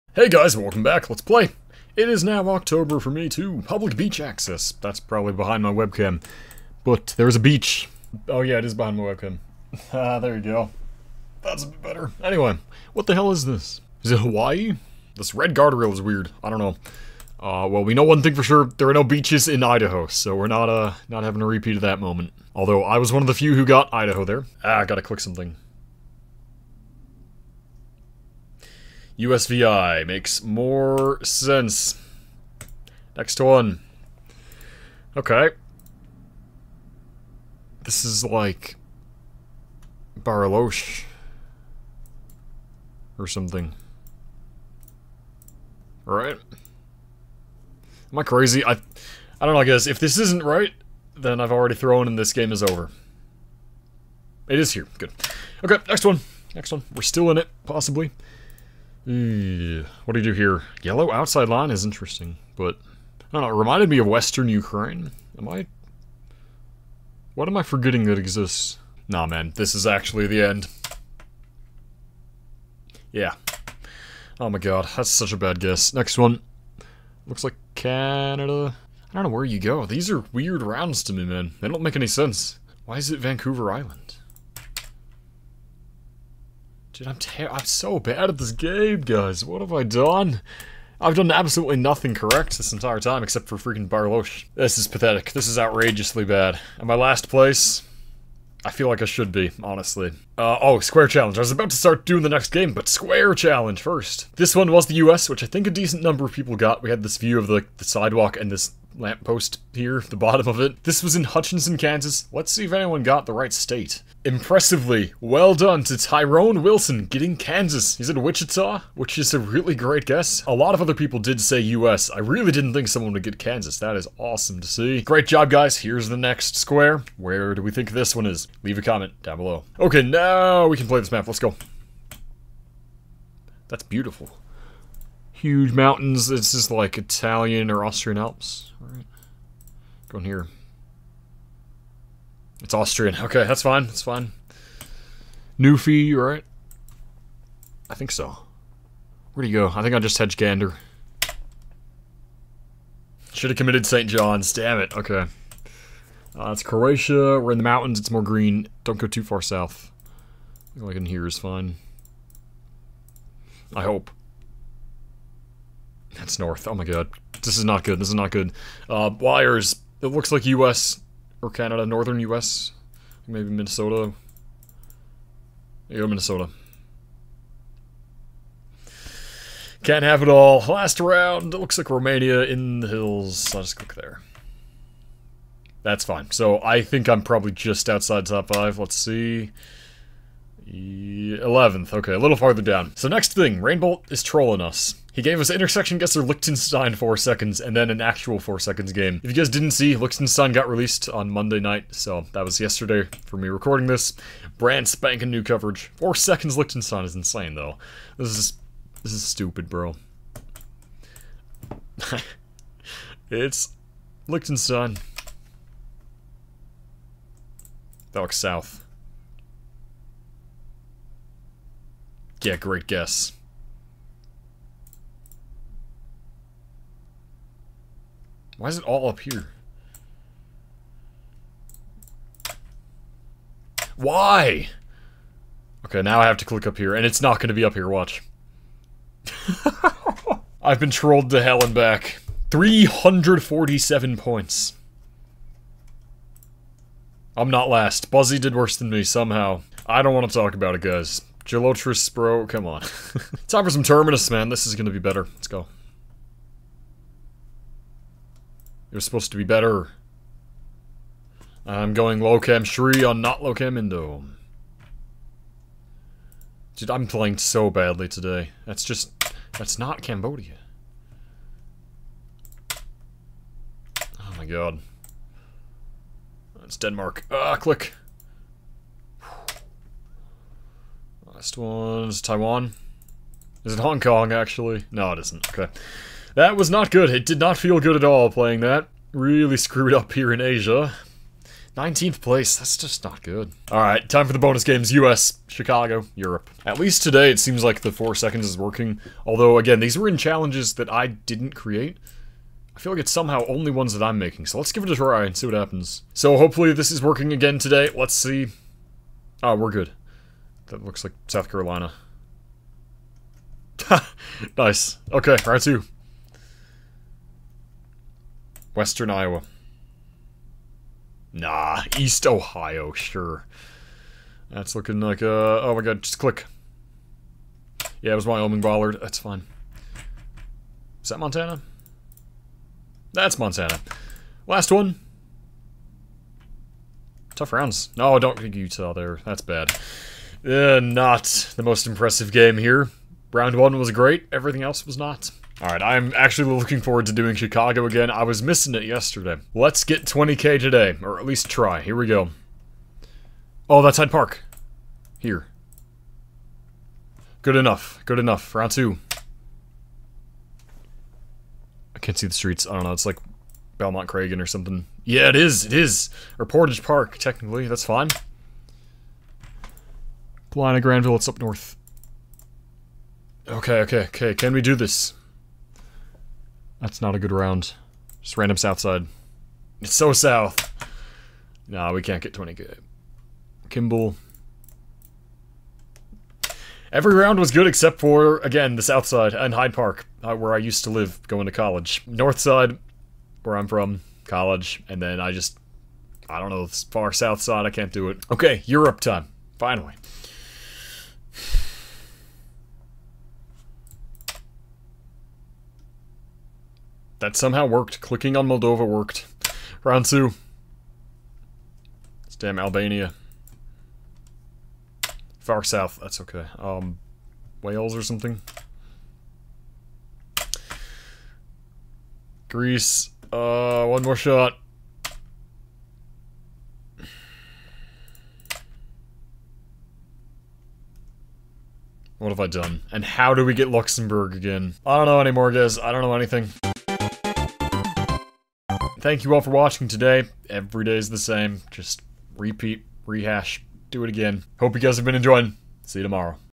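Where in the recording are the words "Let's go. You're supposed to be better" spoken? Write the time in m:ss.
4:15.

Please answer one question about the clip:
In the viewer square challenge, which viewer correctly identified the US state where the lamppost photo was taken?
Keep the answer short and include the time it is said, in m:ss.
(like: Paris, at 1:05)
Tyrone Wilson, at 1:55.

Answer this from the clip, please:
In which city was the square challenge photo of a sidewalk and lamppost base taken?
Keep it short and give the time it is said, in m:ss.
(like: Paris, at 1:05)
Hutchinson, Kansas, at 1:51.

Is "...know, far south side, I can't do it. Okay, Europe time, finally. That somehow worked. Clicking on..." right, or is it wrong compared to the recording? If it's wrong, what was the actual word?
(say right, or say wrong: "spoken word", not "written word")
right.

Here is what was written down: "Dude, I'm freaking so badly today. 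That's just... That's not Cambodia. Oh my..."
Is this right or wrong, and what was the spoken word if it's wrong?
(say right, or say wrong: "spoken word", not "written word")
wrong: "playing", not "freaking".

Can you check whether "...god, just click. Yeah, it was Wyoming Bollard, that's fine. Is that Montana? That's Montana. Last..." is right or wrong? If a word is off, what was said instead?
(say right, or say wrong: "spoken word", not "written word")
right.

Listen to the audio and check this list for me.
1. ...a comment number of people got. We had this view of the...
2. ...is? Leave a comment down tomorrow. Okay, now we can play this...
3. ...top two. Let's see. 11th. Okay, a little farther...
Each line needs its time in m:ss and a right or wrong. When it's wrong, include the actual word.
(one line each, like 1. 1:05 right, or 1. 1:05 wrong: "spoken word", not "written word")
1. 1:45 wrong: "decent", not "comment"
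2. 2:08 wrong: "below", not "tomorrow"
3. 3:08 wrong: "five", not "two".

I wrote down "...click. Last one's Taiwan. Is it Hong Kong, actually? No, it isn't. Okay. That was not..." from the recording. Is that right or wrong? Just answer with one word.
right.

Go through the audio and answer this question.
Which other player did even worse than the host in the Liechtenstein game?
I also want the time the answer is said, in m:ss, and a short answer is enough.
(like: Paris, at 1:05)
Buzzy, at 4:08.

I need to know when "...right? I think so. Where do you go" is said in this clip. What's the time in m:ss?
2:26.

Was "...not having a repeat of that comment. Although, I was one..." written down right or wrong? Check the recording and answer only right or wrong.
wrong.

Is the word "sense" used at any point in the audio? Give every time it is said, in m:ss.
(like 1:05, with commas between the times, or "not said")
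0:31, 1:22.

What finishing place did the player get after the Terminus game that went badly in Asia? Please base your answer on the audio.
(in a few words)
19th.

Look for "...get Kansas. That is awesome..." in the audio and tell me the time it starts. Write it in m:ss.
2:03.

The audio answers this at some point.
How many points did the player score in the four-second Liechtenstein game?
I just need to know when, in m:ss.
4:02.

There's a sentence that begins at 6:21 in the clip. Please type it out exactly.
Nah, we can't get 20 Kimball.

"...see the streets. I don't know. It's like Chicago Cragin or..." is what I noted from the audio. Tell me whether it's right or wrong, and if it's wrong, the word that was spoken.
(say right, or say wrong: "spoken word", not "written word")
wrong: "Belmont", not "Chicago".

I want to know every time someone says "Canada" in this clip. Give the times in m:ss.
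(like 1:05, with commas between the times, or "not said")
1:17, 2:51.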